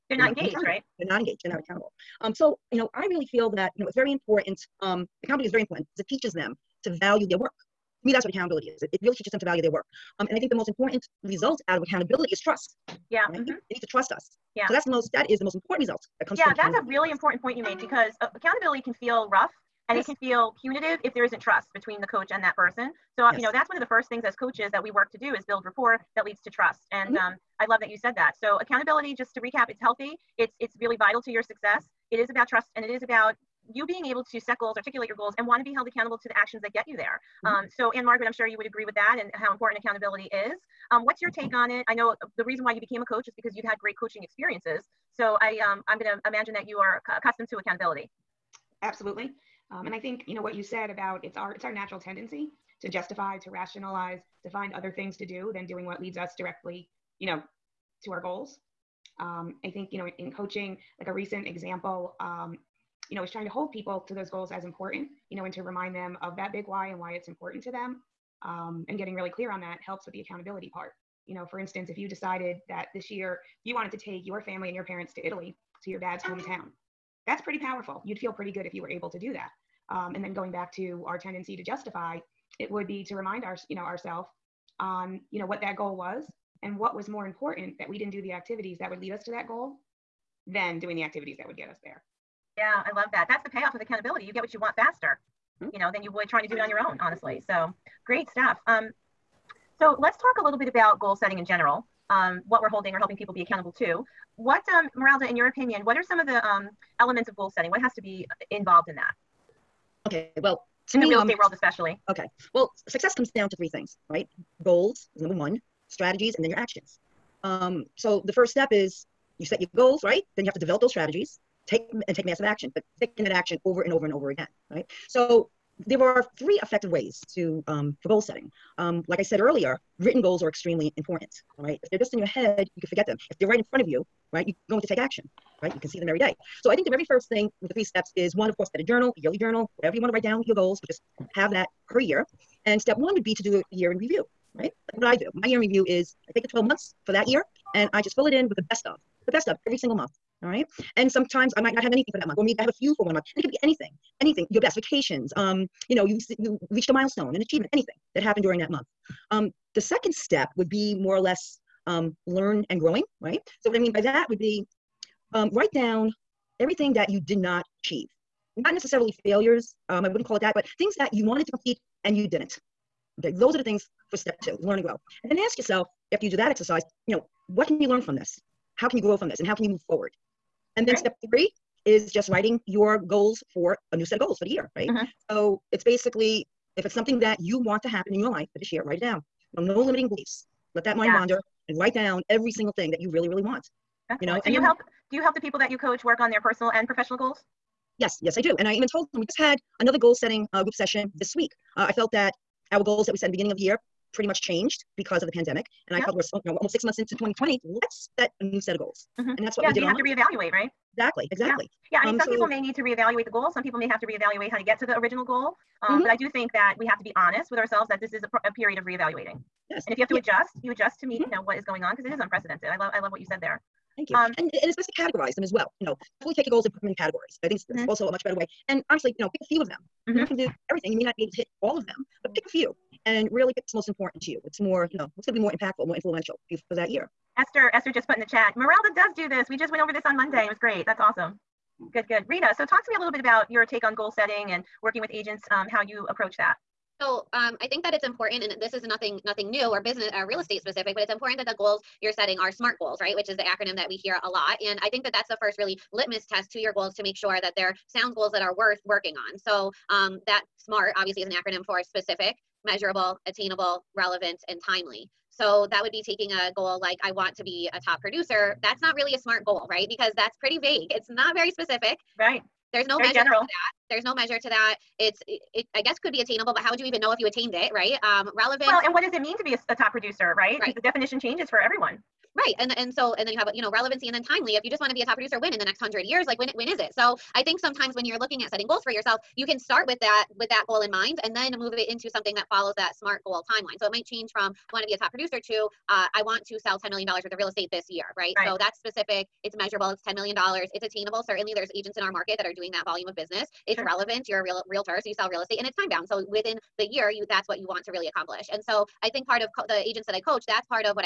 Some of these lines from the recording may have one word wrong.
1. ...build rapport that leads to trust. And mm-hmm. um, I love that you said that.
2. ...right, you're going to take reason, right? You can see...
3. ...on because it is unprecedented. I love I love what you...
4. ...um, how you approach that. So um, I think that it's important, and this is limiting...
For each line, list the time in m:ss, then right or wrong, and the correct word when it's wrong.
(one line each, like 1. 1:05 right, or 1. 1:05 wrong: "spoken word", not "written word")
1. 0:25 right
2. 2:14 wrong: "action", not "reason"
3. 3:41 right
4. 4:05 wrong: "nothing", not "limiting".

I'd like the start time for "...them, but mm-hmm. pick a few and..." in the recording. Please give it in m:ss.
3:51.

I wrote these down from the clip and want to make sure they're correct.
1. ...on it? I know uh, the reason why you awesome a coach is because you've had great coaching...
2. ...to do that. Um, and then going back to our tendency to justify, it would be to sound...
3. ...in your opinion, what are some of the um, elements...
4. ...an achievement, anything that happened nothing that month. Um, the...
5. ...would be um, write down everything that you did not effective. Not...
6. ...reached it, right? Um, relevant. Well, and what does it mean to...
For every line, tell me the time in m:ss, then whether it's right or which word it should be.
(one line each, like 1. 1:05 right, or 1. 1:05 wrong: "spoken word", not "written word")
1. 0:41 wrong: "became", not "awesome"
2. 1:19 wrong: "remind", not "sound"
3. 1:45 right
4. 2:37 wrong: "during", not "nothing"
5. 2:44 wrong: "achieve", not "effective"
6. 4:37 wrong: "attained", not "reached".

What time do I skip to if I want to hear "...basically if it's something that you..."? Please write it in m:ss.
3:05.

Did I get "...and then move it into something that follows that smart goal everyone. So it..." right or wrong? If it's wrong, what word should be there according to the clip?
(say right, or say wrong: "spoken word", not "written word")
wrong: "timeline", not "everyone".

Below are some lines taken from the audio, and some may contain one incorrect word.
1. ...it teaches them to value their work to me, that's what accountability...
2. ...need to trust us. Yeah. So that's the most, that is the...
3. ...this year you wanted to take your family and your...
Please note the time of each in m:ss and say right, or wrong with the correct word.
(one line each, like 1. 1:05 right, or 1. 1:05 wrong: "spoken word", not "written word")
1. 0:06 right
2. 0:13 right
3. 1:12 right.